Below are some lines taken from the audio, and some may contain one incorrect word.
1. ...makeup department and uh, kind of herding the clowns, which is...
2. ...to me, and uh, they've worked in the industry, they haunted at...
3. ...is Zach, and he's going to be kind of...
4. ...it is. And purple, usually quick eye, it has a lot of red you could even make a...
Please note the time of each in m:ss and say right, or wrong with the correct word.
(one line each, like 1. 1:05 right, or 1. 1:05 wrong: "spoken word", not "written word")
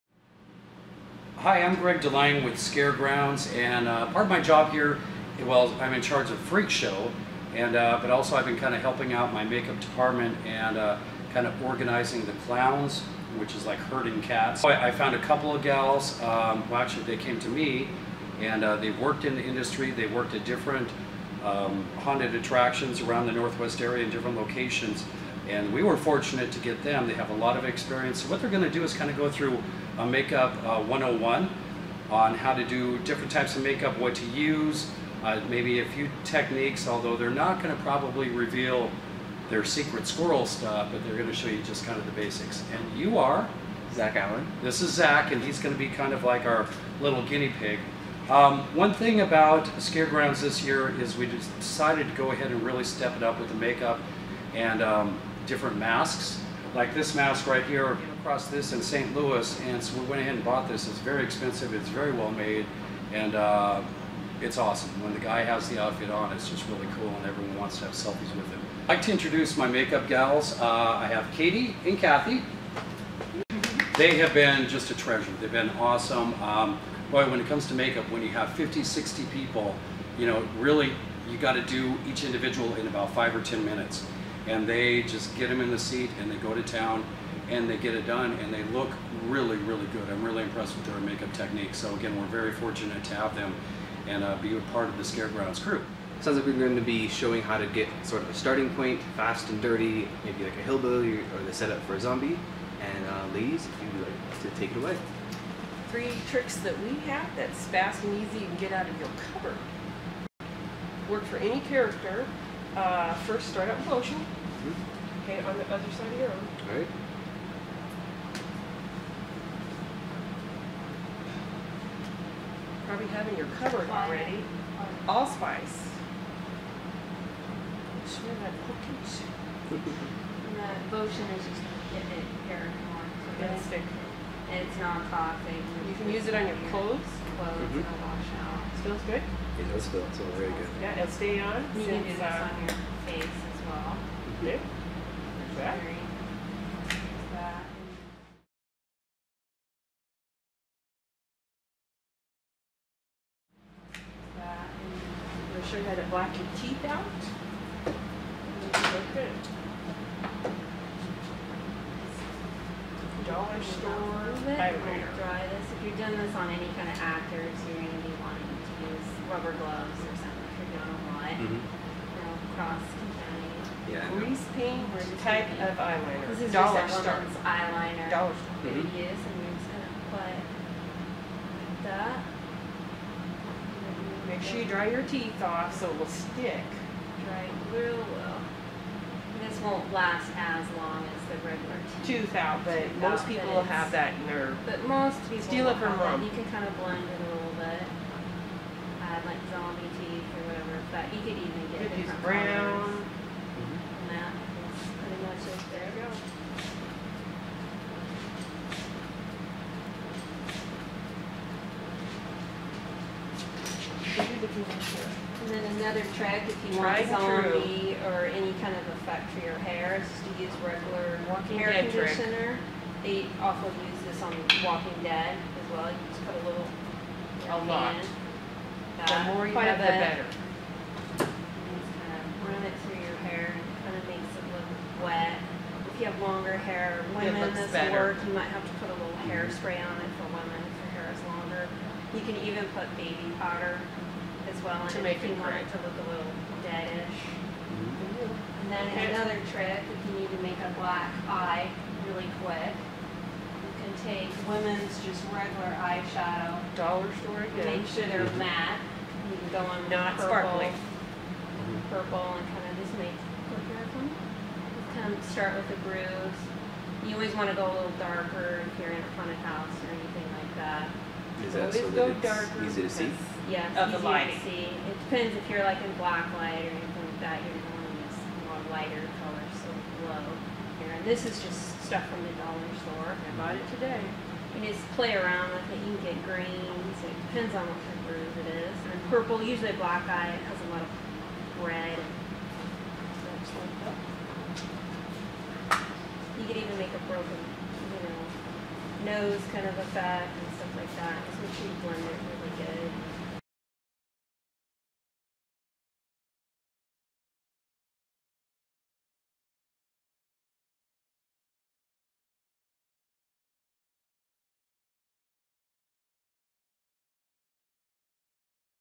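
1. 0:09 wrong: "organizing", not "herding"
2. 0:17 wrong: "worked", not "haunted"
3. 0:44 right
4. 4:48 wrong: "black", not "quick".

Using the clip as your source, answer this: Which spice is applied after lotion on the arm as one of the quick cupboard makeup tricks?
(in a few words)
Allspice.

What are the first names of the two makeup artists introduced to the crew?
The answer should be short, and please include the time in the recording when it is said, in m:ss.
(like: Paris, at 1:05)
Katie and Kathy, at 1:11.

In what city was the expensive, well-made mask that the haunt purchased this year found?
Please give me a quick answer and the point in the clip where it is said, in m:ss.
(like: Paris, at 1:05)
St. Louis, at 0:58.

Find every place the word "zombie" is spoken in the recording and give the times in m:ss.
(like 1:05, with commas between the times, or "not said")
1:42, 3:19, 3:37.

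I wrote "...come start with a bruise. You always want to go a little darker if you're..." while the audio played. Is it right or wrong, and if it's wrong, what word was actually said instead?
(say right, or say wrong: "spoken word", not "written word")
right.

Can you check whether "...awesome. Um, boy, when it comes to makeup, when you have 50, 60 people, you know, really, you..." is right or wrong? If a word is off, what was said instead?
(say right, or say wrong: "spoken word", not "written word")
right.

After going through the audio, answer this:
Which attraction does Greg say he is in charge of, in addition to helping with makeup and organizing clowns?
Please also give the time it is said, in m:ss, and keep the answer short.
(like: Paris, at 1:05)
Freak Show, at 0:06.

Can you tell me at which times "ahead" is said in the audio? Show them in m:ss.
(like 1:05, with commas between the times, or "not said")
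0:52, 1:00.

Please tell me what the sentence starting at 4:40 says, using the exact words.
And this is just stuff from the dollar store.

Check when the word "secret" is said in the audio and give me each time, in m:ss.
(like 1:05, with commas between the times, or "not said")
0:39.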